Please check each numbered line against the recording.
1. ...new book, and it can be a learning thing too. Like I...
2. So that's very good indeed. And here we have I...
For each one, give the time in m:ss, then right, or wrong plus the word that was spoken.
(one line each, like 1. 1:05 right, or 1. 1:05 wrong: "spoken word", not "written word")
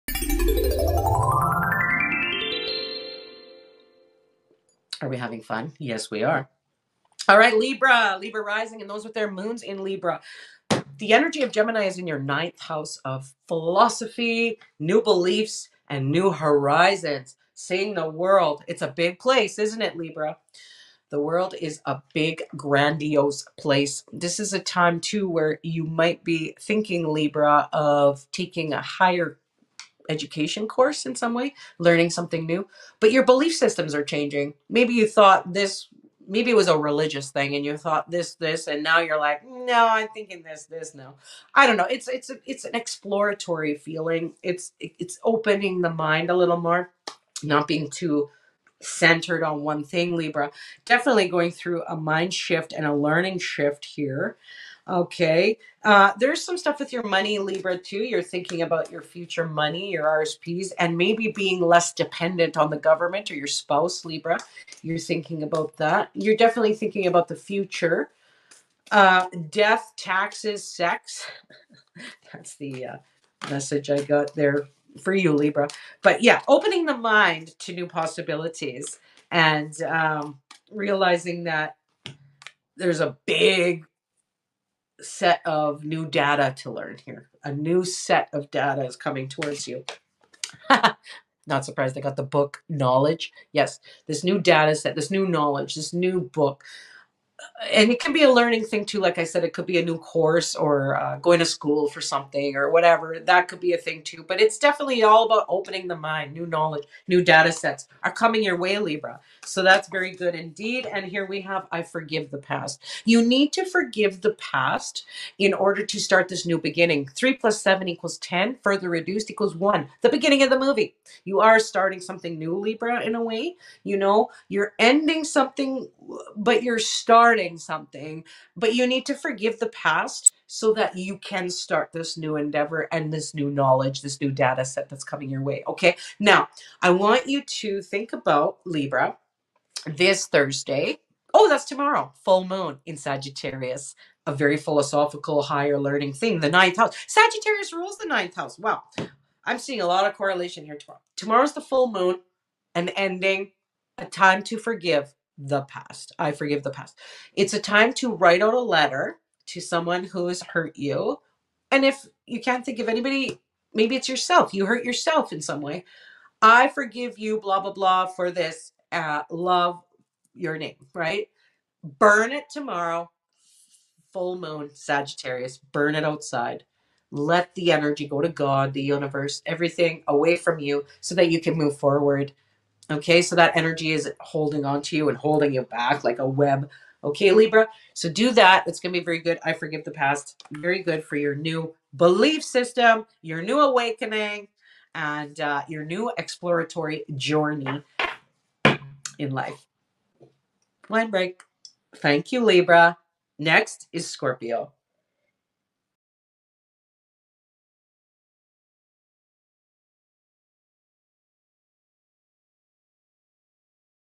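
1. 1:35 right
2. 1:49 right.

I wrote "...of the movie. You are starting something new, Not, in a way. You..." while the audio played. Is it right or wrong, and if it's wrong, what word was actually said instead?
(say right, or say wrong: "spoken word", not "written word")
wrong: "Libra", not "Not".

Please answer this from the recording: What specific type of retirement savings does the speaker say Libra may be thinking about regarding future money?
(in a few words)
RSPs.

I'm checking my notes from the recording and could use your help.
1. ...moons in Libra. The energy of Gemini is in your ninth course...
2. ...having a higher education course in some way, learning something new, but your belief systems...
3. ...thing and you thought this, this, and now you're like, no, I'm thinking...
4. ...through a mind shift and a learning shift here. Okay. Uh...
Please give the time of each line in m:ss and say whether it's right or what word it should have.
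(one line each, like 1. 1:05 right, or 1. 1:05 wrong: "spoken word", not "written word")
1. 0:09 wrong: "house", not "course"
2. 0:28 wrong: "taking", not "having"
3. 0:37 right
4. 0:51 right.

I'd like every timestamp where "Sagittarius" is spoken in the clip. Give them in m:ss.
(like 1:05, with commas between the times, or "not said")
2:22, 2:27, 2:54.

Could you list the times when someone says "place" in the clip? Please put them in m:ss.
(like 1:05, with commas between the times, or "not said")
0:19, 0:23.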